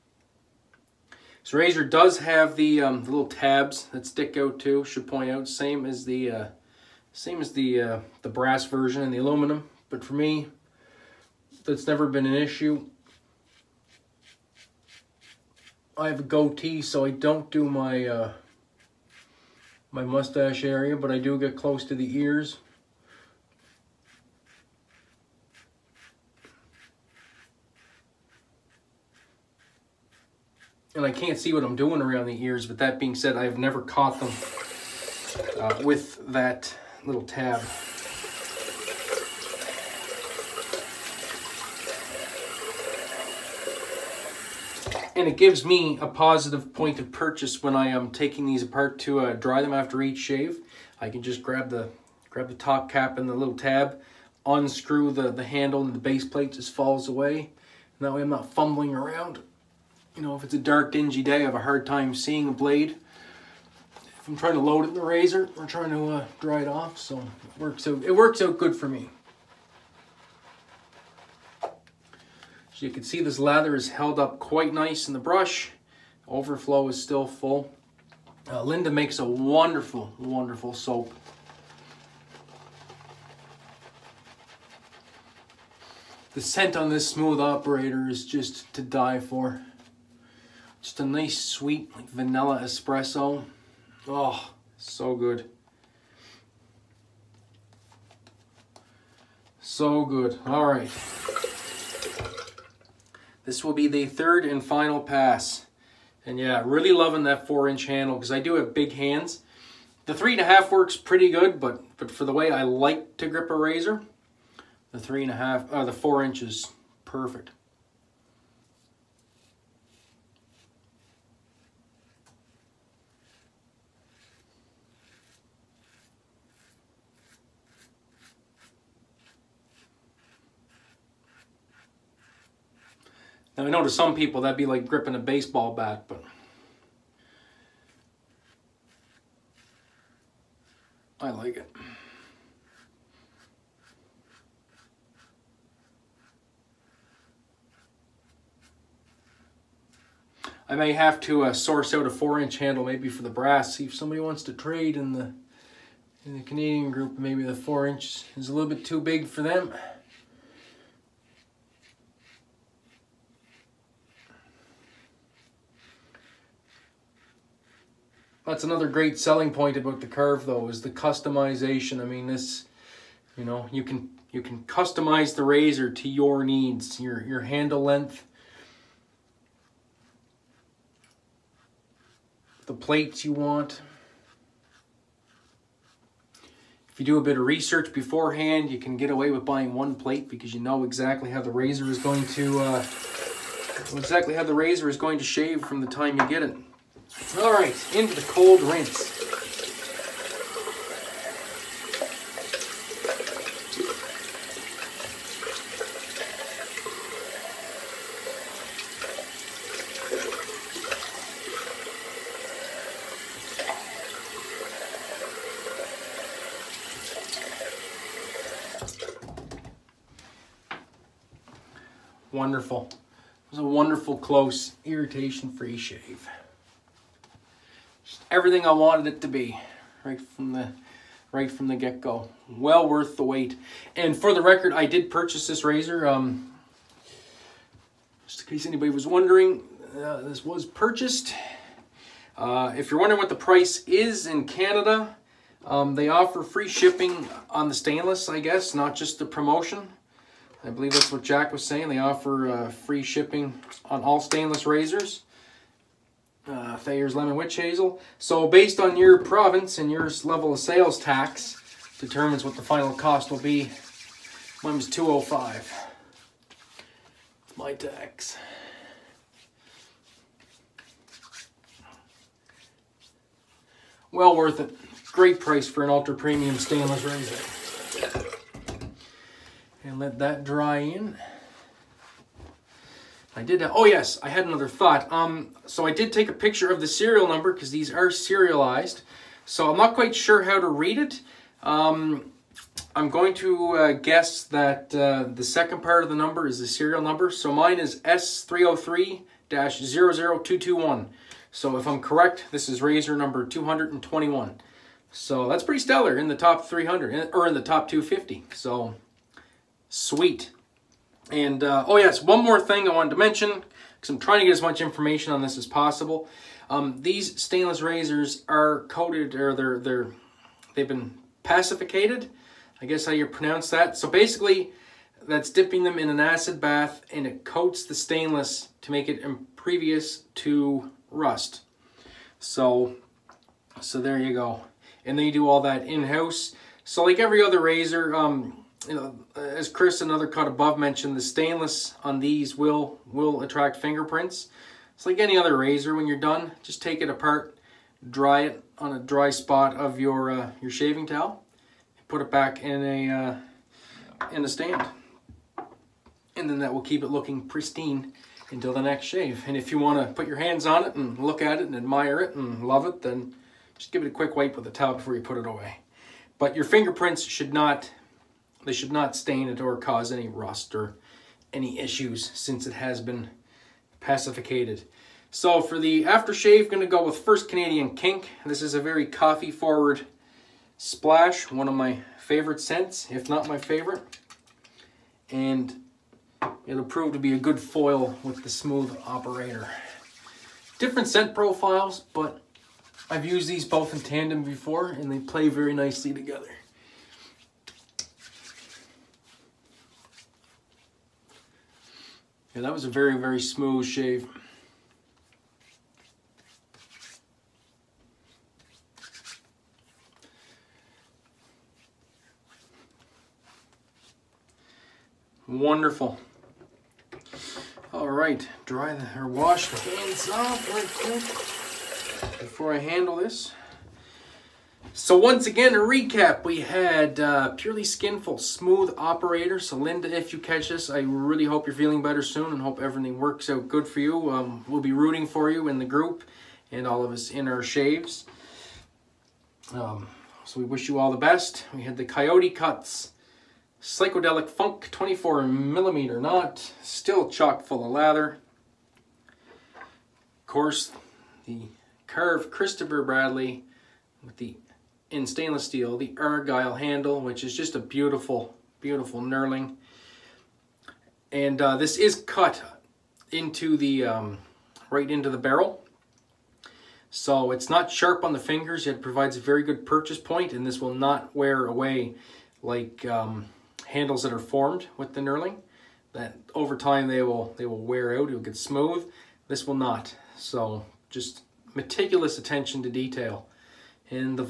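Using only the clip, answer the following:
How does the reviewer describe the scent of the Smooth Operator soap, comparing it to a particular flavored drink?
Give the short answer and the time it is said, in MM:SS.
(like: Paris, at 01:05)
Vanilla espresso, at 01:32.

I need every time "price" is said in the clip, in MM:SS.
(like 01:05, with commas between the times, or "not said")
04:03, 04:35.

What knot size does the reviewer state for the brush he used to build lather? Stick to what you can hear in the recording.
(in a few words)
24 millimeter.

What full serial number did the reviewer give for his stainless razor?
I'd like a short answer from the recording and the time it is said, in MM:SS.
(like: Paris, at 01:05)
S303-00221, at 04:58.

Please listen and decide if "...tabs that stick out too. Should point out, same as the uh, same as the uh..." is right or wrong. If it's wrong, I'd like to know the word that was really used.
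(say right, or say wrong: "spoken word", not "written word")
right.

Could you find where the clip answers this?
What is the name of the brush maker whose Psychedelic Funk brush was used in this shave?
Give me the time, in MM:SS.
07:22.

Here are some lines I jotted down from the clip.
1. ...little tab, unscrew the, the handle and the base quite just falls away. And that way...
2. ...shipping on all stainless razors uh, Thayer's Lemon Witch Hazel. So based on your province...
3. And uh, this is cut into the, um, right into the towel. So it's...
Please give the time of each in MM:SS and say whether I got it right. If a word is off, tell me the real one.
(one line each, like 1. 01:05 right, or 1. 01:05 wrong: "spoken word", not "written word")
1. 00:53 wrong: "plate", not "quite"
2. 04:13 right
3. 07:41 wrong: "barrel", not "towel".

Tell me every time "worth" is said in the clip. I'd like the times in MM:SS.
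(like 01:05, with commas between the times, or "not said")
03:52, 04:34.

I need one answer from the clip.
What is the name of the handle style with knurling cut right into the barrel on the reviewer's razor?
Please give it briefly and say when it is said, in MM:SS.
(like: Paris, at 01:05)
Argyle, at 07:36.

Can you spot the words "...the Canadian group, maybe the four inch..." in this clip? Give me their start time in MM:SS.
02:36.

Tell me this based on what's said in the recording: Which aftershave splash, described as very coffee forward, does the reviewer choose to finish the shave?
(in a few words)
First Canadian Kink.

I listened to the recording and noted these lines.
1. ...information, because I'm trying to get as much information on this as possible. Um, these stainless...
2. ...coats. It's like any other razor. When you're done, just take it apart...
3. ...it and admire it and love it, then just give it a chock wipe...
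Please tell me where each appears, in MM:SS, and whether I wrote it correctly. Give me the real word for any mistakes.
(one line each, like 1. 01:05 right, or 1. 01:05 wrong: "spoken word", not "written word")
1. 05:13 wrong: "mention", not "information"
2. 05:43 wrong: "fingerprints", not "coats"
3. 06:01 wrong: "quick", not "chock".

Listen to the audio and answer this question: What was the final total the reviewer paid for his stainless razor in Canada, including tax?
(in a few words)
205.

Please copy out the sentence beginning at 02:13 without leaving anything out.
Now, I know to some people that'd be like gripping a baseball bat, but I like it.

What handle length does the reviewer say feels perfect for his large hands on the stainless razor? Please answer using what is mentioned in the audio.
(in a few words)
4 inches.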